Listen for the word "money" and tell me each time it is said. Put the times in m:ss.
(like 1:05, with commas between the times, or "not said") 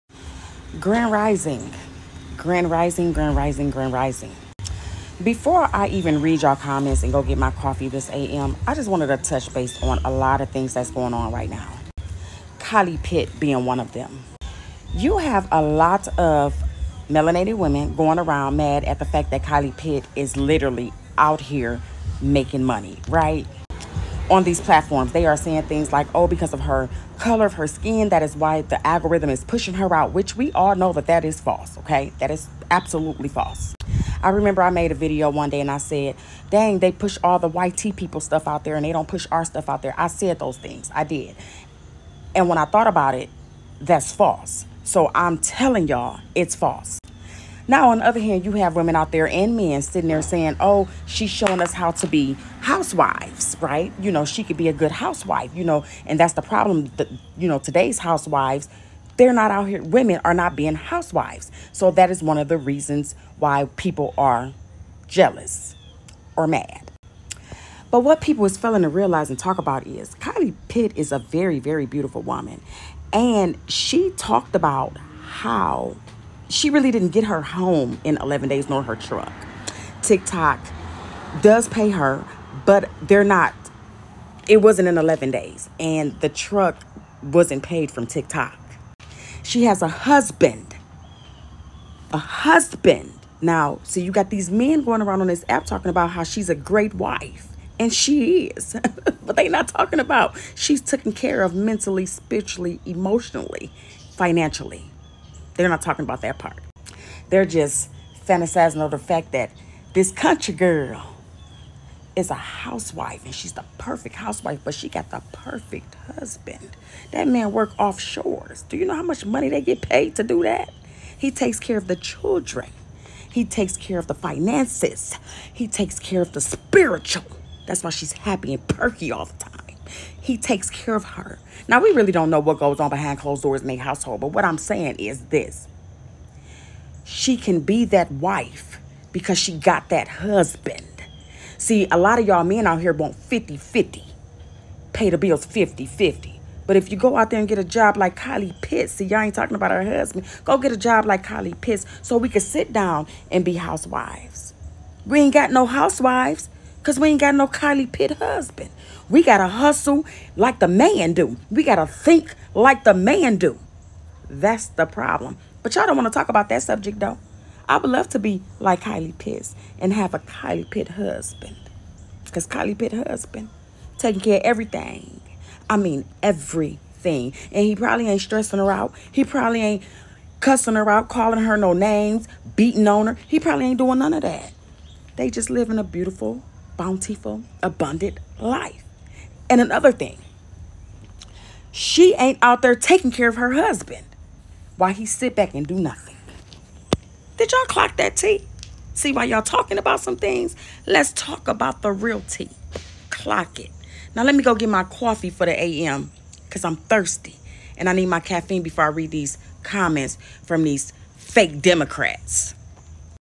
0:22, 1:59.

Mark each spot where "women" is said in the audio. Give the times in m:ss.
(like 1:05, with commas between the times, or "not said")
0:17, 0:48, 0:59.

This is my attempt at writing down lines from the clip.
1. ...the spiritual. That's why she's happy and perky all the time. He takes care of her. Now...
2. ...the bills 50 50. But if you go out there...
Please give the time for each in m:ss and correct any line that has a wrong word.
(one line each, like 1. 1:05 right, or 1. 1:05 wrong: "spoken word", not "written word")
1. 2:06 right
2. 2:25 right.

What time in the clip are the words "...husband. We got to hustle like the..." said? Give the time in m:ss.
2:38.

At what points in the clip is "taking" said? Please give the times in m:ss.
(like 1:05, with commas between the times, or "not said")
2:53, 3:12.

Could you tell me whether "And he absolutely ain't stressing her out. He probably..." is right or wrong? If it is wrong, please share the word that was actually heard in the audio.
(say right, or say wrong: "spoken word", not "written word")
wrong: "probably", not "absolutely".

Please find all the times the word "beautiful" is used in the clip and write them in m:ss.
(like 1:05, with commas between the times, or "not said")
1:11, 3:05.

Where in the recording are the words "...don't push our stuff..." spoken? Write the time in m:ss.
0:38.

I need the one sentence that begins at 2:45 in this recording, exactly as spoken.
But y'all don't want to talk about that subject, though.